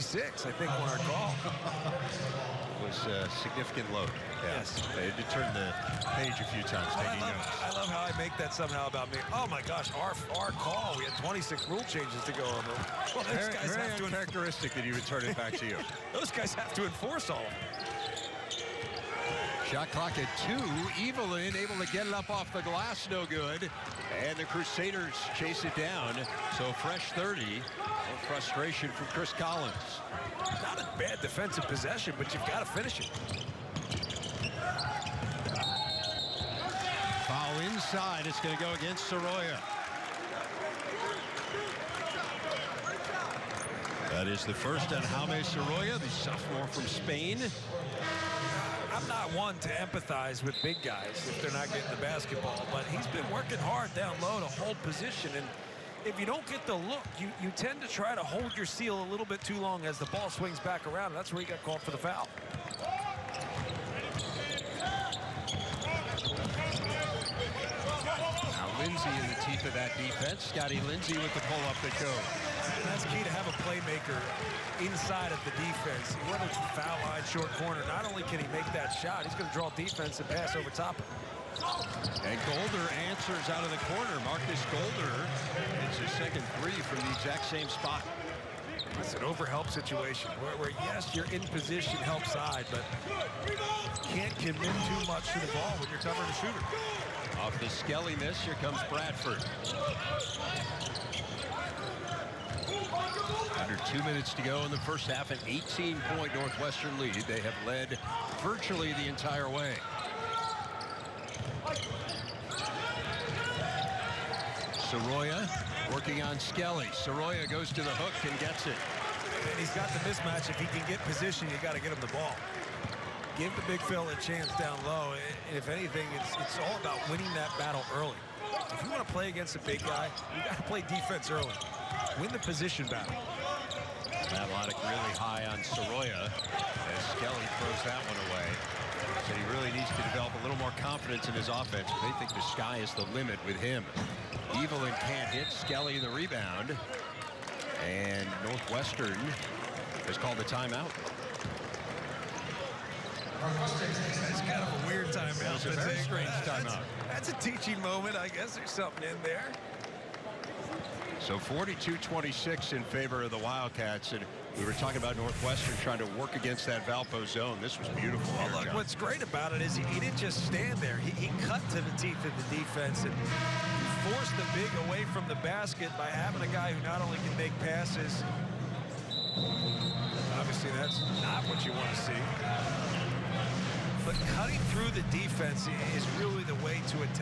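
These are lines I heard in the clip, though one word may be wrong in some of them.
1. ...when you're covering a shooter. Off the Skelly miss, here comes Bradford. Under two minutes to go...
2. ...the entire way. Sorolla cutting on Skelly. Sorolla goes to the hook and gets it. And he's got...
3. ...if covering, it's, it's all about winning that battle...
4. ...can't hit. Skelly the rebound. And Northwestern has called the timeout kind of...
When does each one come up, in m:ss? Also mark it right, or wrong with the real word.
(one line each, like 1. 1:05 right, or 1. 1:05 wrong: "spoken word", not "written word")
1. 1:35 right
2. 1:48 wrong: "working", not "cutting"
3. 2:05 wrong: "anything", not "covering"
4. 2:25 right.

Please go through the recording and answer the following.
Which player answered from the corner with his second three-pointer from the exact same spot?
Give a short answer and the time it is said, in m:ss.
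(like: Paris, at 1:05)
Markus Golder, at 1:24.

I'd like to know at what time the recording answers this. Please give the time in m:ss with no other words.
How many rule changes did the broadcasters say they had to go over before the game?
0:11.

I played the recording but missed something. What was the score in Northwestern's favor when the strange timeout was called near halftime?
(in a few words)
42-26.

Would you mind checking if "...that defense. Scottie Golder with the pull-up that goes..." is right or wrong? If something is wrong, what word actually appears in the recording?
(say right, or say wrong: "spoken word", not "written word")
wrong: "Lindsey", not "Golder".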